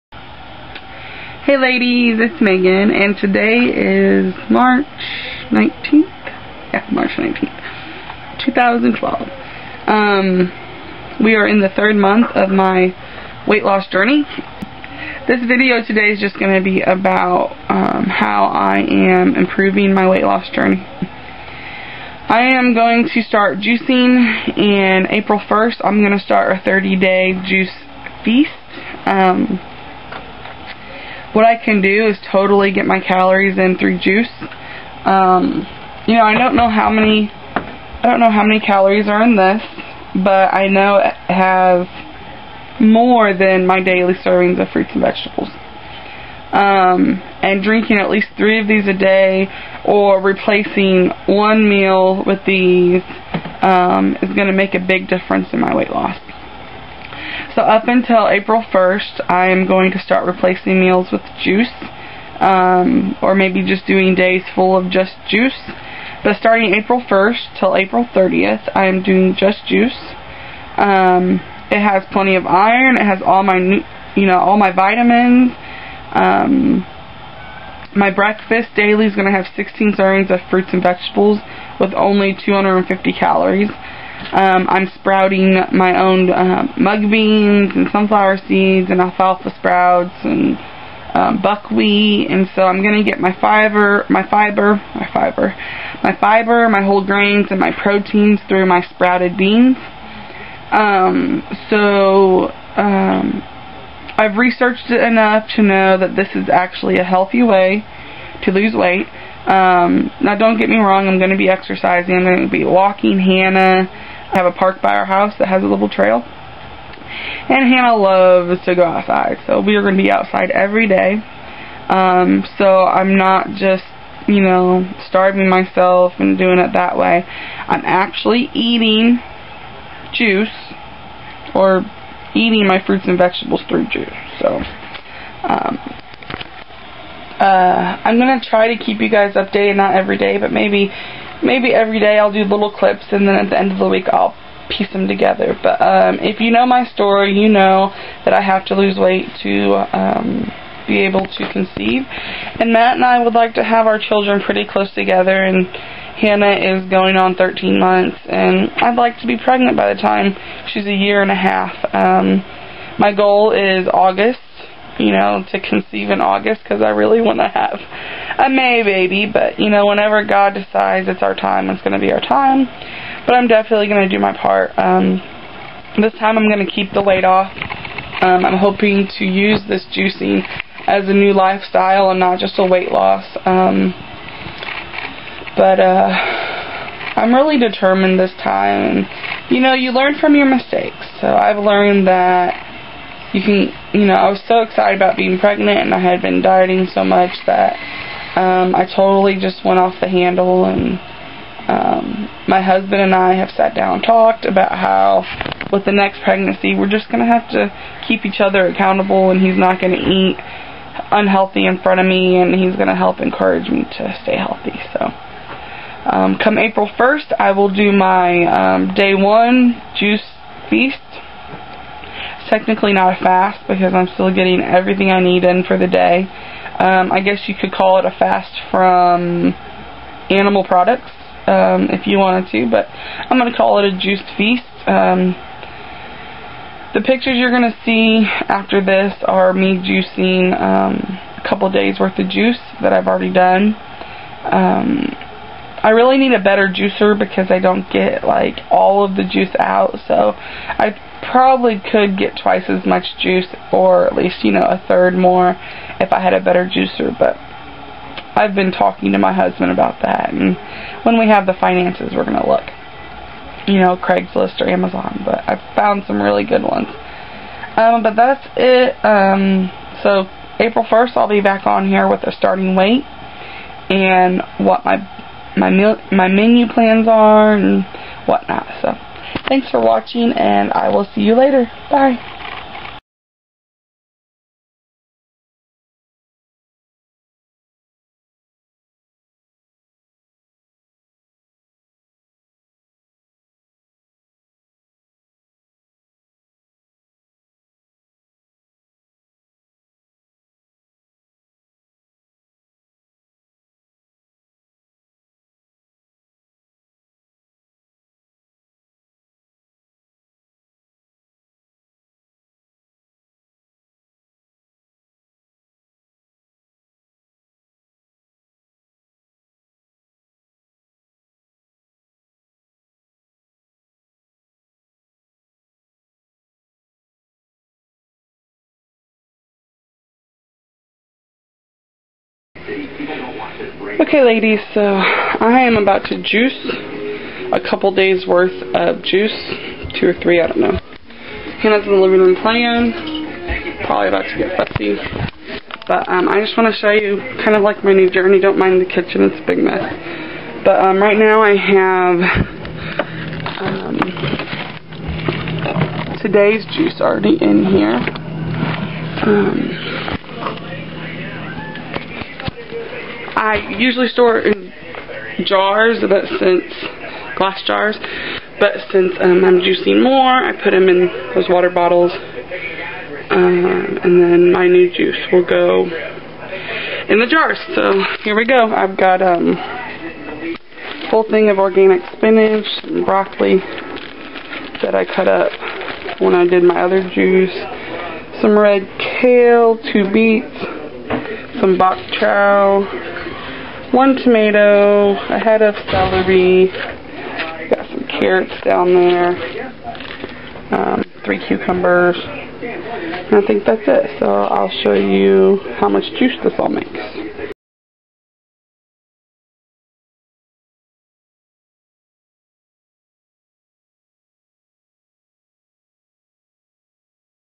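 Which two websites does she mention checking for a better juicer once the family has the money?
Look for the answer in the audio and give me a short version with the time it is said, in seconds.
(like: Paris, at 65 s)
Craigslist or Amazon, at 263 s.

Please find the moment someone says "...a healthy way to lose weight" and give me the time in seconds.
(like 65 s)
106 s.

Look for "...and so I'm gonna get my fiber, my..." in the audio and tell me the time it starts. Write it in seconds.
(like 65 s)
92 s.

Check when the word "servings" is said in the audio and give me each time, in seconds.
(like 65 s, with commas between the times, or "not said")
44 s, 79 s.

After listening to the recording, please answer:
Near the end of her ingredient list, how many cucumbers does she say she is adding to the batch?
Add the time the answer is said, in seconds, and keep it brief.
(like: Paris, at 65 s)
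3, at 401 s.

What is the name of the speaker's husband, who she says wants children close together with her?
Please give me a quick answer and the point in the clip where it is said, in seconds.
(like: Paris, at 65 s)
Matt, at 152 s.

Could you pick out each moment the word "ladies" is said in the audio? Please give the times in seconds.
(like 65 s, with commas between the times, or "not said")
1 s, 334 s.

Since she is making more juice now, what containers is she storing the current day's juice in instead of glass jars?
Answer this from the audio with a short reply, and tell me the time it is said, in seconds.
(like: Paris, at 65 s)
water bottles, at 371 s.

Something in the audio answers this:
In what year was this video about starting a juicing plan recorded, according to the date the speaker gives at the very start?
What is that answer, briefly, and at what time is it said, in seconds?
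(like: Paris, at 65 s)
2012, at 8 s.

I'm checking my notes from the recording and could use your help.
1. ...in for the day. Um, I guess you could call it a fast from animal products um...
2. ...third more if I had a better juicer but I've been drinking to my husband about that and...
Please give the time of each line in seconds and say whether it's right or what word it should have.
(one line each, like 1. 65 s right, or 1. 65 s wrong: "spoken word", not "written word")
1. 225 s right
2. 254 s wrong: "talking", not "drinking".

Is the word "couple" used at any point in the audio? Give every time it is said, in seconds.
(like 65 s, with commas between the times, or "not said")
241 s, 337 s.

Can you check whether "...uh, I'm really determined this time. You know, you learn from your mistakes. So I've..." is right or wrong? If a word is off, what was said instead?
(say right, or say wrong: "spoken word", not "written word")
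right.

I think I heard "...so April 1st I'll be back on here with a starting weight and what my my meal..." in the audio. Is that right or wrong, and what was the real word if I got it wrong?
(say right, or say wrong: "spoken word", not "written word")
right.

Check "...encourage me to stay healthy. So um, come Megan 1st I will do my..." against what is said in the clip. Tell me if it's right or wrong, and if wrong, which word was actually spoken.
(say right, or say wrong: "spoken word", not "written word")
wrong: "April", not "Megan".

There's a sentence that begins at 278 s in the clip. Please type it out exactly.
So, thanks for watching, and I will see you later.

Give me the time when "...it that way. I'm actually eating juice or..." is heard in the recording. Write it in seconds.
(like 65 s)
126 s.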